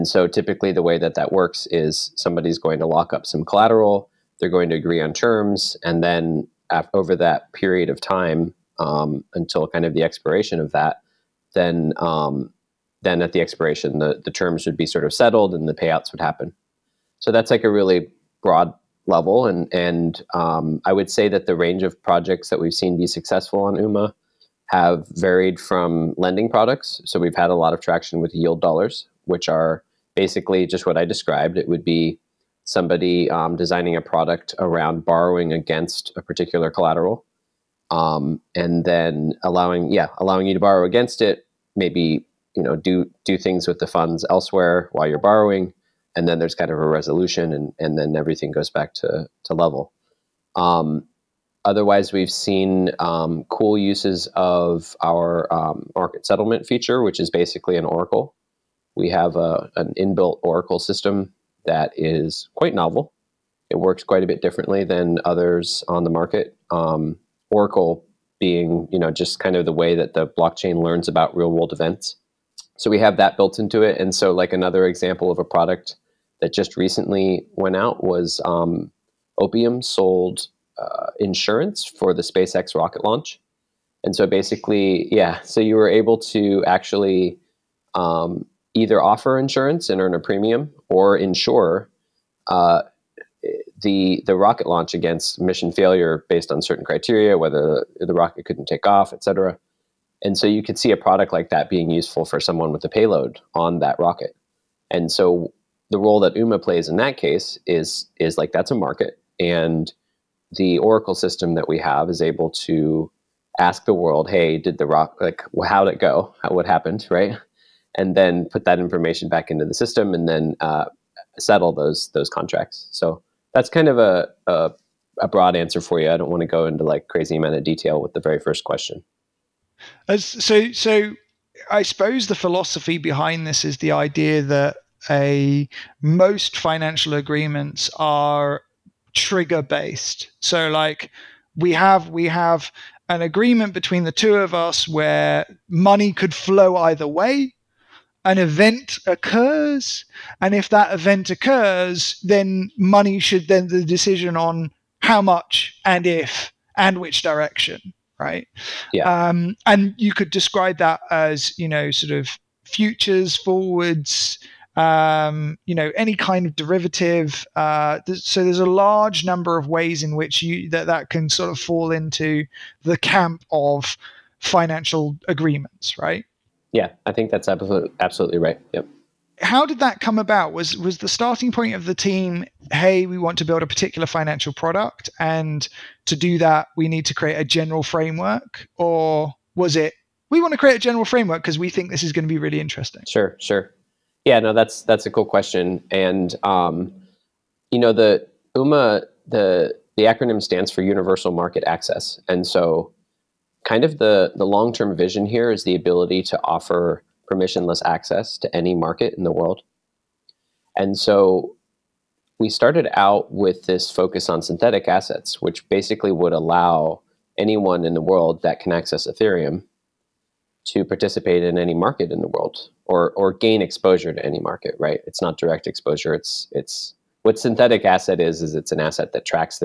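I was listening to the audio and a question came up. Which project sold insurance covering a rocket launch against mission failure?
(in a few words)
Opium.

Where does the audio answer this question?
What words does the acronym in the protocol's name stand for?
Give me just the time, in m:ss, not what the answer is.
3:20.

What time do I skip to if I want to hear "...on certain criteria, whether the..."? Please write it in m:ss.
1:36.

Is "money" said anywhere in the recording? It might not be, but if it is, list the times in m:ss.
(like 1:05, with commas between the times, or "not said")
2:25, 2:32.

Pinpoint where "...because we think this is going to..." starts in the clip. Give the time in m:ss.
3:11.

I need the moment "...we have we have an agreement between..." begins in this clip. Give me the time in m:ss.
2:21.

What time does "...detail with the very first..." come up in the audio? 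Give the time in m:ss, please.
2:07.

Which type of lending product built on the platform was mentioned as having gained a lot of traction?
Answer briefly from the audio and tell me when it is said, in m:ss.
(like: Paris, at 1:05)
Yield dollars, at 0:28.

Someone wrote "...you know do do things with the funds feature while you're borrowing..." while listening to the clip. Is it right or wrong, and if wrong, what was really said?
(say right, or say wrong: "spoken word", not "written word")
wrong: "elsewhere", not "feature".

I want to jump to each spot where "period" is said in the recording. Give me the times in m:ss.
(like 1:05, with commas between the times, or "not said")
0:07.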